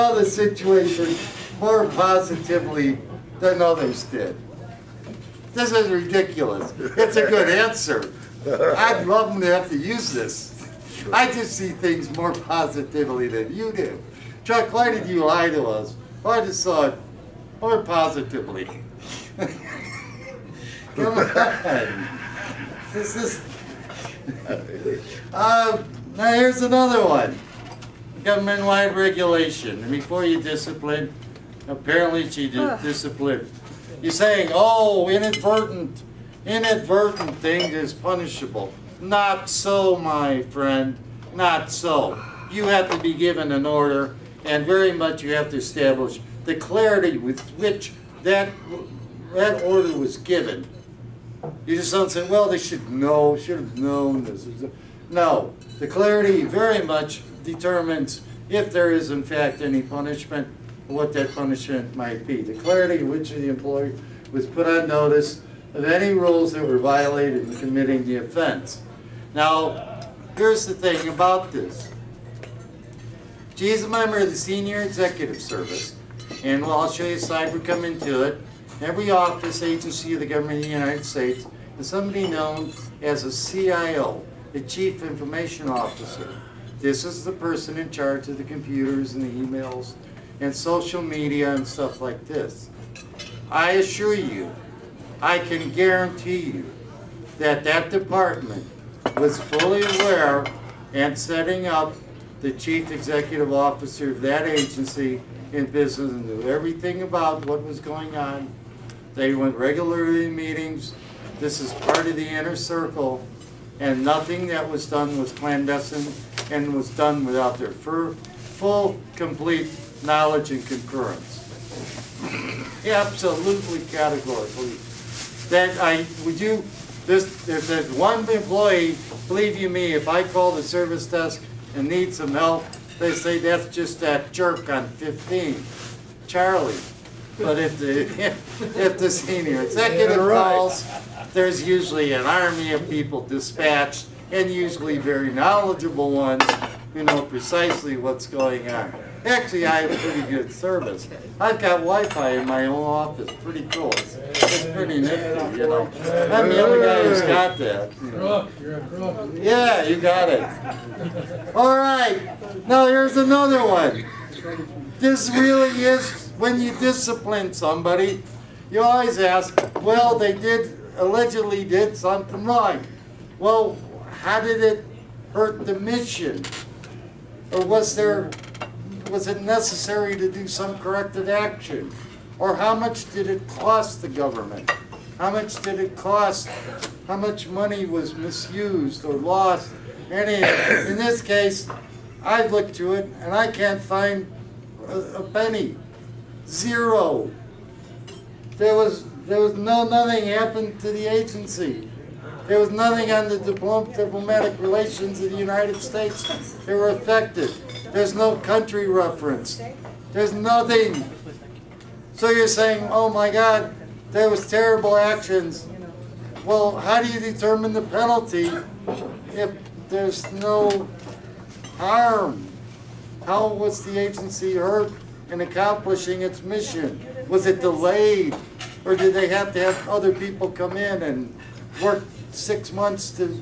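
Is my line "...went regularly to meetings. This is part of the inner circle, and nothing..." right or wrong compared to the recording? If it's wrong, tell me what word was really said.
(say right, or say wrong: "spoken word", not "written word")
right.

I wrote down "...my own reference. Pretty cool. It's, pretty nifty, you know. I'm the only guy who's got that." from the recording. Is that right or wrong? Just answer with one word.
wrong.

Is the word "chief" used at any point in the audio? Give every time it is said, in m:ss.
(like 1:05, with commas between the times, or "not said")
1:24, 1:42.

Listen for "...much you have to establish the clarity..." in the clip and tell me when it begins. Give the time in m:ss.
0:44.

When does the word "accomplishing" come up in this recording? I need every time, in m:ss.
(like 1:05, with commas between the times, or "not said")
3:45.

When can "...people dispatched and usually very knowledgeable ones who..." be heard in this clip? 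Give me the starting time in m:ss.
2:22.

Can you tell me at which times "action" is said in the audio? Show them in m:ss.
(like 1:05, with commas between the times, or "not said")
3:01, 3:34.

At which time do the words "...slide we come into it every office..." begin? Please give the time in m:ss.
1:17.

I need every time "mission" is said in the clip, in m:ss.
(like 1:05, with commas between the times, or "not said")
2:55, 3:46.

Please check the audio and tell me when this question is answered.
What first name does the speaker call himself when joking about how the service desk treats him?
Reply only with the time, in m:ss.
2:16.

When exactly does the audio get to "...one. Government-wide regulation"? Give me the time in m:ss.
0:27.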